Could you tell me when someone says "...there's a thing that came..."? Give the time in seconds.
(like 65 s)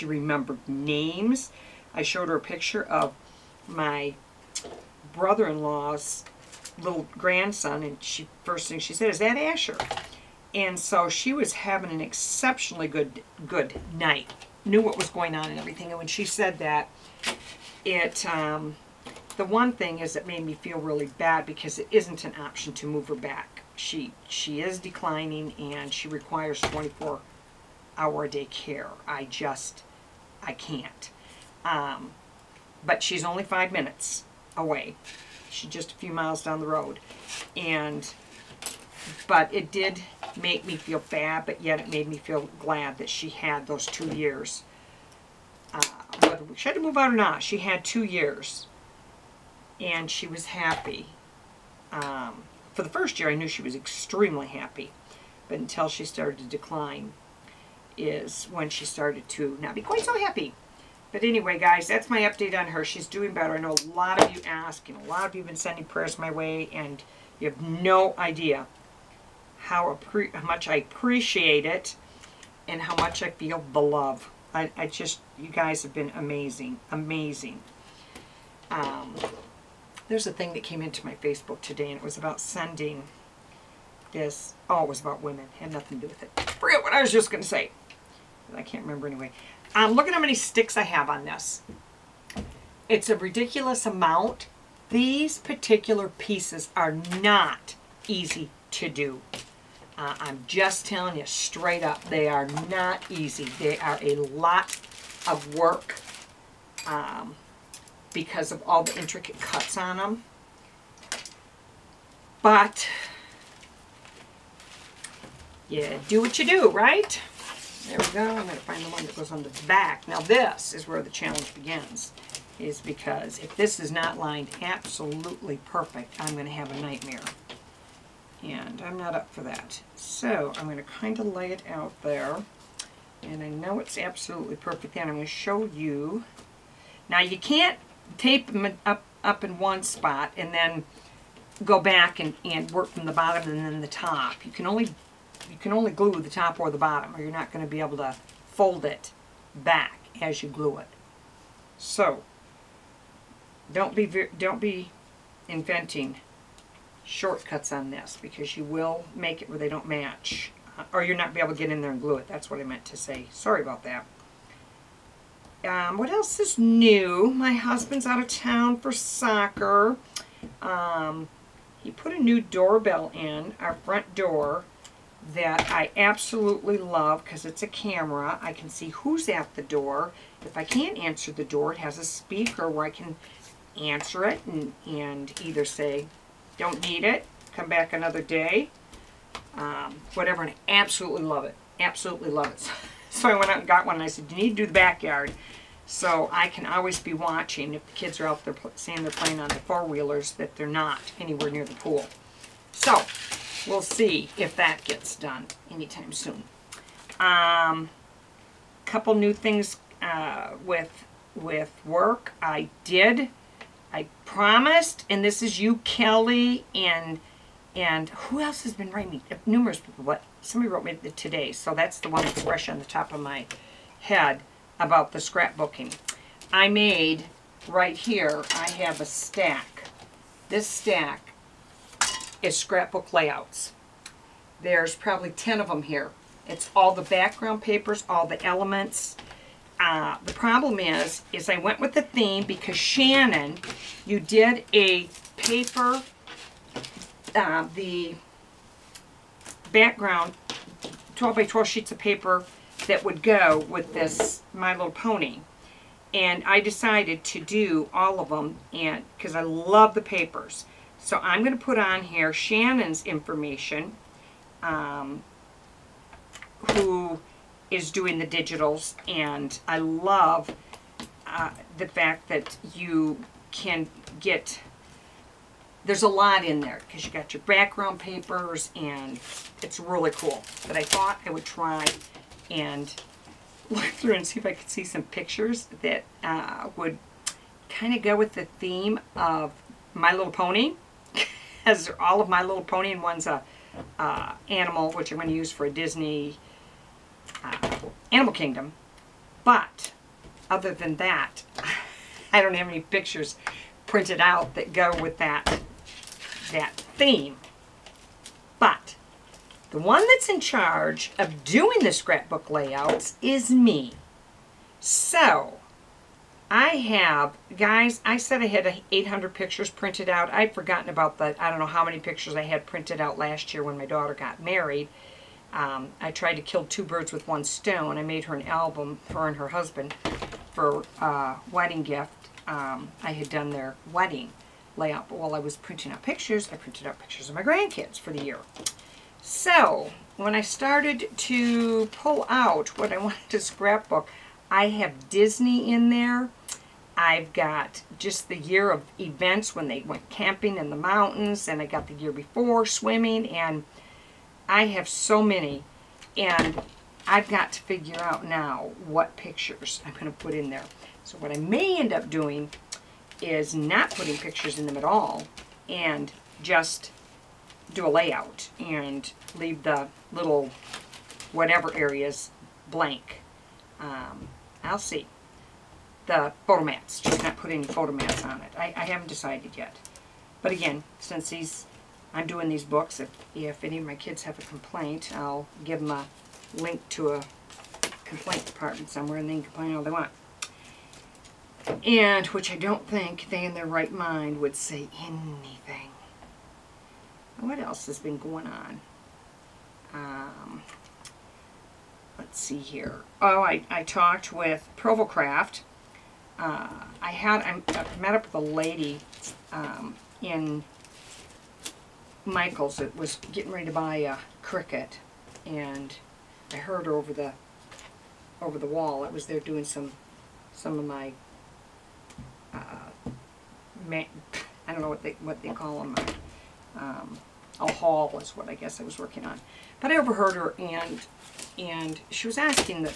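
80 s.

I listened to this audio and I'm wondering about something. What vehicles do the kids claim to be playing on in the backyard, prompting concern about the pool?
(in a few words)
Four-wheelers.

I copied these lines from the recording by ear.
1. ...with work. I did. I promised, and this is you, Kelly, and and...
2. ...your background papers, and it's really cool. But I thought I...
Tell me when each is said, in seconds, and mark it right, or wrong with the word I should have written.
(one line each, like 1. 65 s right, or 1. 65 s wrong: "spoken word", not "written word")
1. 211 s right
2. 277 s right.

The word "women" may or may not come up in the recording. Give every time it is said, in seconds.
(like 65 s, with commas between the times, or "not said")
85 s.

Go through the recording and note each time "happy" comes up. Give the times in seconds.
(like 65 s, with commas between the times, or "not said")
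50 s, 54 s, 60 s.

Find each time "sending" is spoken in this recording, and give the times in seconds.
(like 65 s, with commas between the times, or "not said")
65 s, 82 s.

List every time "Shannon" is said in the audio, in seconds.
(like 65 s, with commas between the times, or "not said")
242 s, 262 s.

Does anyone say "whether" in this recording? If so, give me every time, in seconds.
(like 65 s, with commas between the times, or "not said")
46 s.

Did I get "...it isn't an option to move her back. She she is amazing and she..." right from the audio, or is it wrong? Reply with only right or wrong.
wrong.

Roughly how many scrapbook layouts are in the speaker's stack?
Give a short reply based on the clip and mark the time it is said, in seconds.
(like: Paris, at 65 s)
10, at 235 s.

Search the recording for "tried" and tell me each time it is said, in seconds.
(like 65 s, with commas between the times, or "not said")
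326 s.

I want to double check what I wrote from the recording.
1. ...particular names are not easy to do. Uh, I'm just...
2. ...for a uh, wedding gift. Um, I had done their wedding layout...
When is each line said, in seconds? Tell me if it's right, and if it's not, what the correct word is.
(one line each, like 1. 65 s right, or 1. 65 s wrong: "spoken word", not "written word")
1. 95 s wrong: "pieces", not "names"
2. 330 s right.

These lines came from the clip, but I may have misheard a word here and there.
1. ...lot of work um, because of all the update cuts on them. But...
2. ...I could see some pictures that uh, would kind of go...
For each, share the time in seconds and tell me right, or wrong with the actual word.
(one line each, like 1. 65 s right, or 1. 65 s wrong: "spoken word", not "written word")
1. 104 s wrong: "intricate", not "update"
2. 284 s right.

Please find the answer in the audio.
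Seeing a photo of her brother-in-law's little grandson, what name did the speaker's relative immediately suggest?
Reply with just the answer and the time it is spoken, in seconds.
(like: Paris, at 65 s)
Asher, at 9 s.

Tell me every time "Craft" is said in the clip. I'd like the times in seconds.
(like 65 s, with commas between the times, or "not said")
405 s.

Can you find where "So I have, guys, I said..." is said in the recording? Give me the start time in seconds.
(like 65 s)
314 s.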